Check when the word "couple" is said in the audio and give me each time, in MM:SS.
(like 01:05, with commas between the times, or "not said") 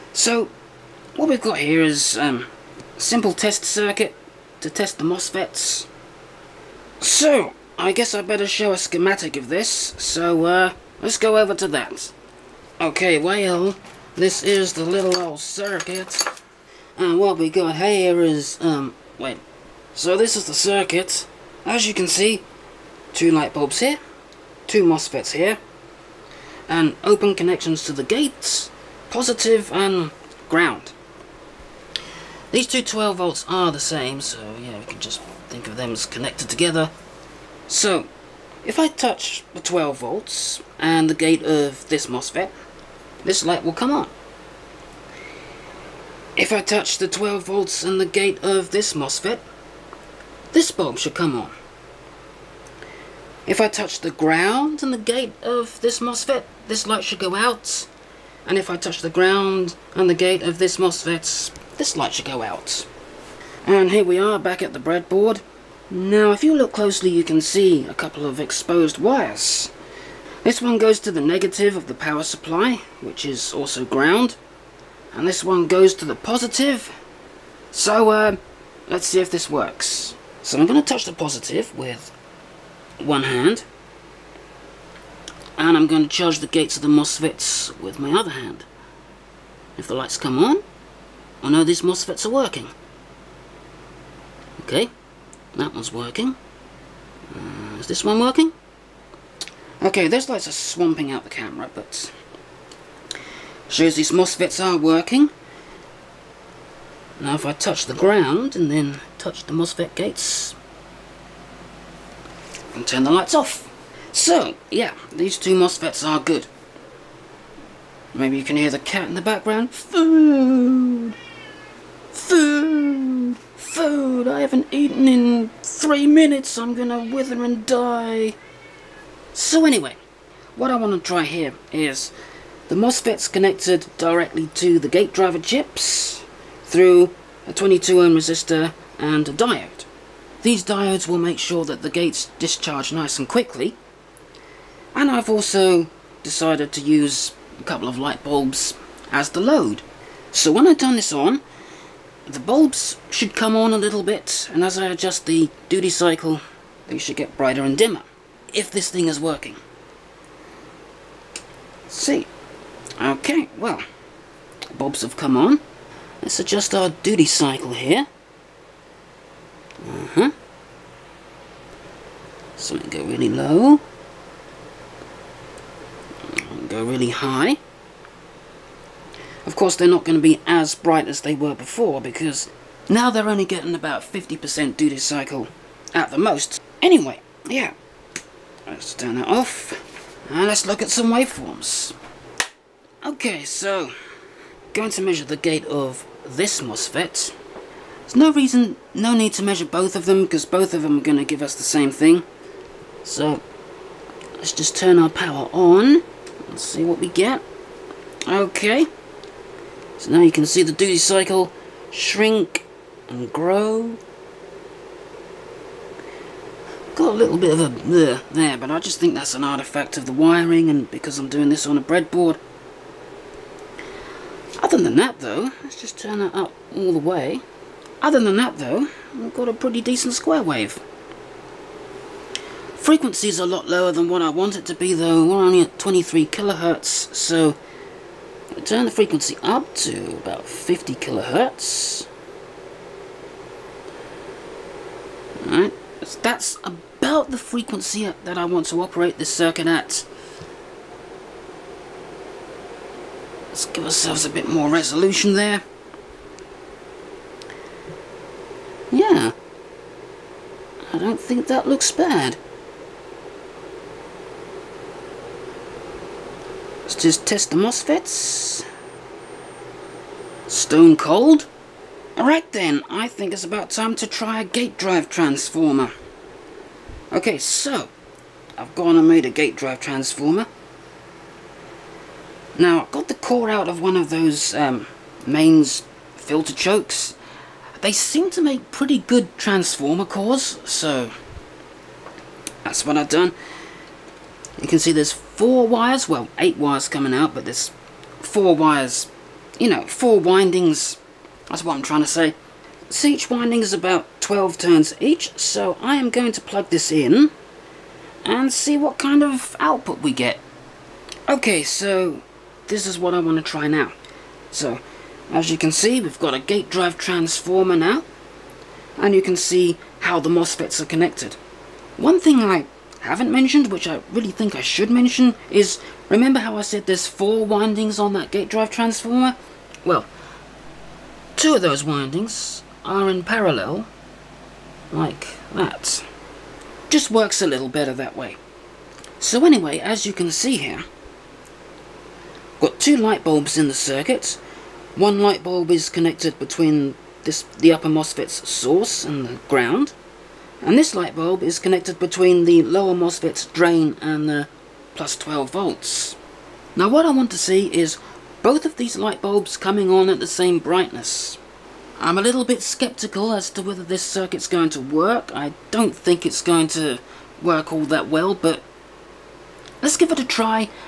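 01:07, 02:27.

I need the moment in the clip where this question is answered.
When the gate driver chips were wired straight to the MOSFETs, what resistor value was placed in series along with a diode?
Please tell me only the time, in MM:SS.
02:17.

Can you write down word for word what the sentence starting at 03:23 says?
So let's just turn our power on and see what we get.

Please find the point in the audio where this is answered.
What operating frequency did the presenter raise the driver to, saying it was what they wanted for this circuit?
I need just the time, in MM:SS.
04:00.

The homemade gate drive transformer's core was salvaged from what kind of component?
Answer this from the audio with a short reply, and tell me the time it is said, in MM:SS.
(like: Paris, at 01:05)
mains filter chokes, at 04:45.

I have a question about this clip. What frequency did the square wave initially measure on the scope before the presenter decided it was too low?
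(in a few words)
23 kilohertz.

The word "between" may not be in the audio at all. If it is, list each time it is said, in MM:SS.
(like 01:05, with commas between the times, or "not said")
05:46, 05:51.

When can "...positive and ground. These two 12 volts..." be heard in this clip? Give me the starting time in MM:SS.
00:29.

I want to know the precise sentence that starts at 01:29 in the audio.
If the lights come on, I oh, know these MOSFETs are working.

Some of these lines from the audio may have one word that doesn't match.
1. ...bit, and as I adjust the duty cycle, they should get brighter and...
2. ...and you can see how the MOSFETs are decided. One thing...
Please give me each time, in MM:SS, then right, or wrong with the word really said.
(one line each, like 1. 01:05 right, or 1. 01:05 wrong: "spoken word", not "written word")
1. 02:34 right
2. 05:18 wrong: "connected", not "decided".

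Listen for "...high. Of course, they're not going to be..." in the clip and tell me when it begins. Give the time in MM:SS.
02:57.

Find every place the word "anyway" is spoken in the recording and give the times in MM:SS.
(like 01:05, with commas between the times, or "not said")
02:09, 03:06, 05:39.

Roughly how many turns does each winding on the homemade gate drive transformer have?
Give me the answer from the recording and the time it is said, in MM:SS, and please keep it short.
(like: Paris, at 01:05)
12, at 05:04.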